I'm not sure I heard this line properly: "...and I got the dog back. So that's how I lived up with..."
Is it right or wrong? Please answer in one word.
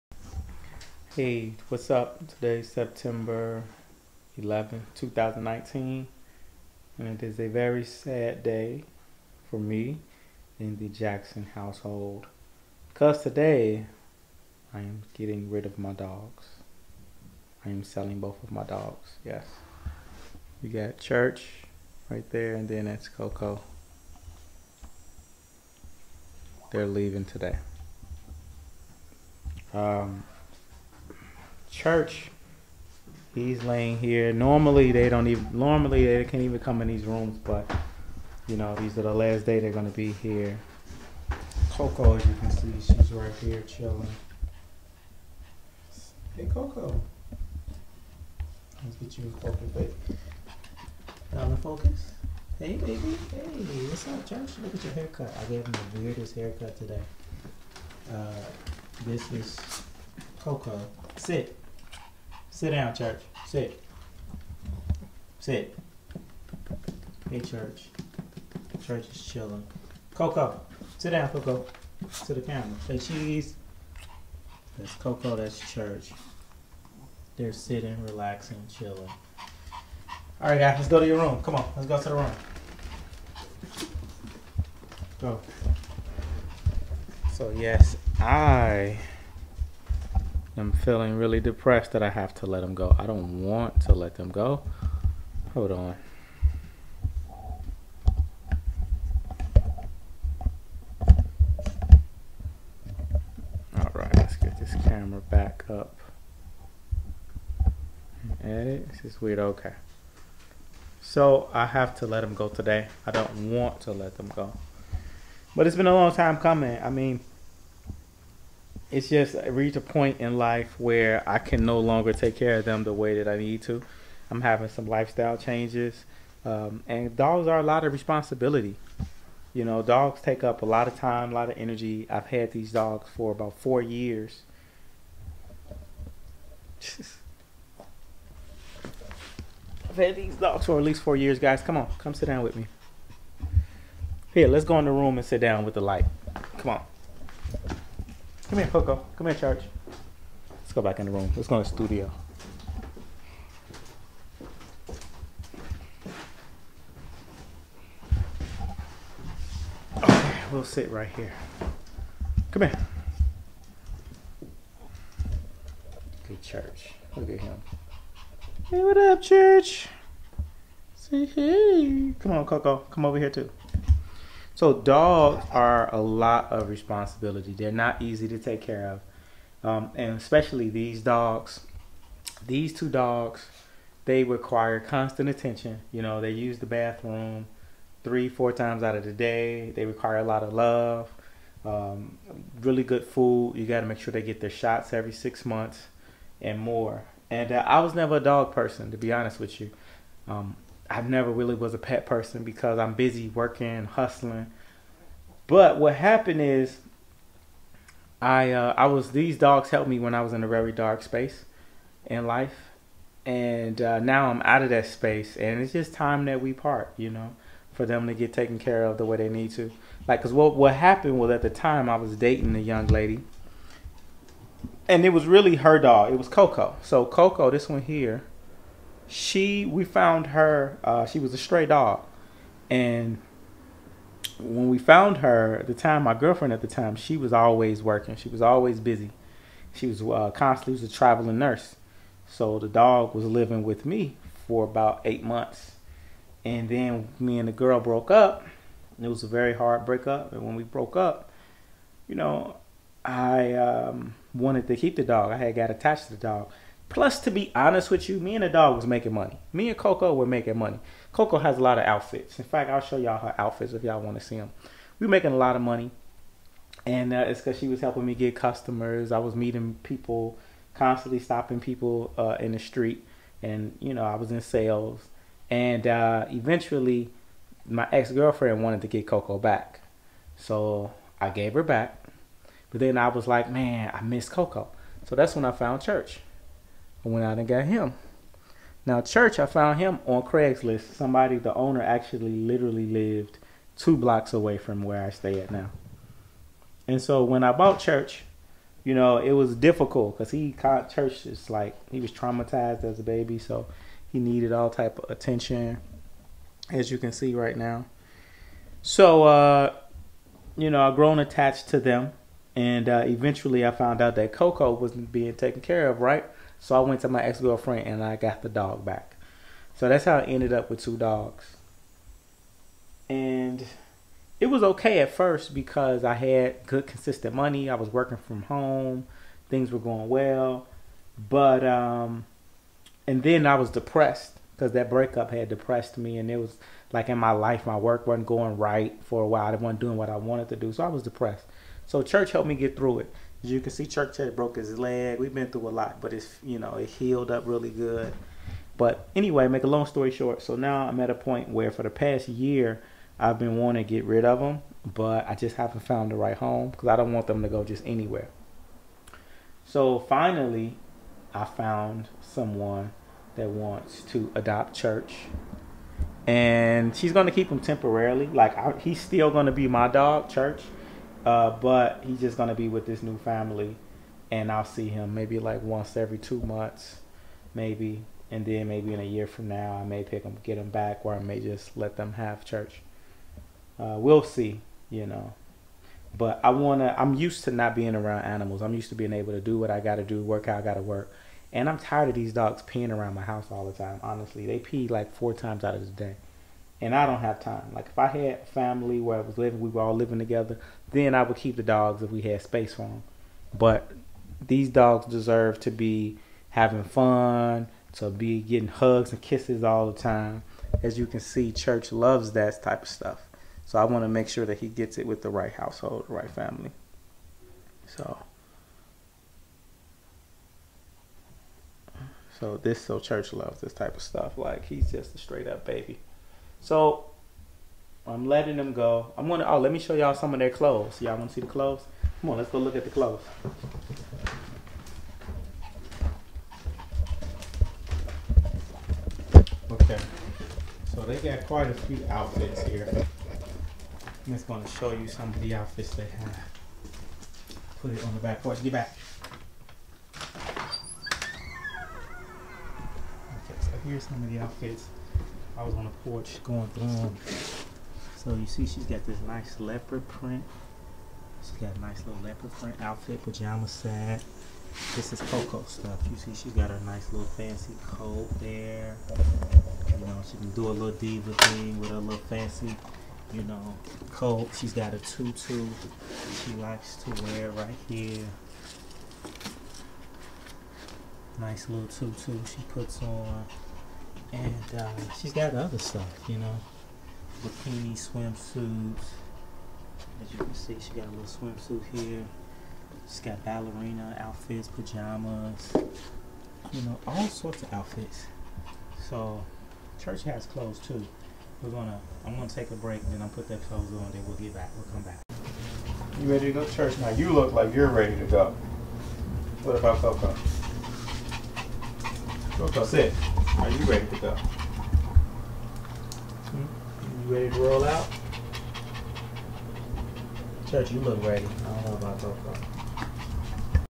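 wrong.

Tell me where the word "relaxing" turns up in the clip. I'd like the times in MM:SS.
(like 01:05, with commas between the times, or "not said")
01:18.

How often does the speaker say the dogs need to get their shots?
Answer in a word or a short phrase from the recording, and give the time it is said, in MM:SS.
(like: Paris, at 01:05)
every 6 months, at 03:14.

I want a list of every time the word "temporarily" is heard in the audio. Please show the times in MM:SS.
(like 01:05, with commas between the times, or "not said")
06:07.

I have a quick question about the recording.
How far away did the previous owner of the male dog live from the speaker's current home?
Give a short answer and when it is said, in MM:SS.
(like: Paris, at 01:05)
2 blocks, at 04:53.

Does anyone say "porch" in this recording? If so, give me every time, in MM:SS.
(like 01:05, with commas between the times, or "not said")
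07:28, 07:36.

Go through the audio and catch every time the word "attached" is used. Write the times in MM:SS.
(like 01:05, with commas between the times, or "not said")
04:15, 05:11.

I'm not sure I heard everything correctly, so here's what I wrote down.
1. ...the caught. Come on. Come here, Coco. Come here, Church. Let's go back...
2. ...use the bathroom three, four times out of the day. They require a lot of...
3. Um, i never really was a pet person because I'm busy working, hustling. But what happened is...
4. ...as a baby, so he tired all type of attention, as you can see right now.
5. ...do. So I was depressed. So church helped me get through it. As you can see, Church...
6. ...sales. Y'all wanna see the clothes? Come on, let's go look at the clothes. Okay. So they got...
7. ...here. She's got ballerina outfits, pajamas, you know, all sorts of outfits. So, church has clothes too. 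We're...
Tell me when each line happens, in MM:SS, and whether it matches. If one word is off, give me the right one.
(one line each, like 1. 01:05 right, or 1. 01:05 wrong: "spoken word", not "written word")
1. 02:25 wrong: "light", not "caught"
2. 03:06 right
3. 03:20 right
4. 05:02 wrong: "needed", not "tired"
5. 05:40 right
6. 07:10 wrong: "clothes", not "sales"
7. 08:11 right.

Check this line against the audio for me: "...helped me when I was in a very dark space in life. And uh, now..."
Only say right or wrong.
right.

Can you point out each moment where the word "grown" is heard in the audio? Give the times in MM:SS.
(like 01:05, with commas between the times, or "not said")
05:10.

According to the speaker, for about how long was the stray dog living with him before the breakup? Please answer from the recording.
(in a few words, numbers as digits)
8 months.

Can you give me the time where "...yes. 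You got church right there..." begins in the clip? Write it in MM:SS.
00:19.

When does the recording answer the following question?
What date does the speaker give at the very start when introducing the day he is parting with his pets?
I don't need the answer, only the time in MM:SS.
00:02.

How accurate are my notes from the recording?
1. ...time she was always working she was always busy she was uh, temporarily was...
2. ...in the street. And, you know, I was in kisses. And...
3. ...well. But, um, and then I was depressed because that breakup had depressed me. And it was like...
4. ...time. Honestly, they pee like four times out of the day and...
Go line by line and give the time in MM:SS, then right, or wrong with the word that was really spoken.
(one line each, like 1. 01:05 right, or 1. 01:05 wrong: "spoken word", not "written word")
1. 03:56 wrong: "constantly", not "temporarily"
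2. 04:32 wrong: "sales", not "kisses"
3. 05:30 right
4. 06:33 right.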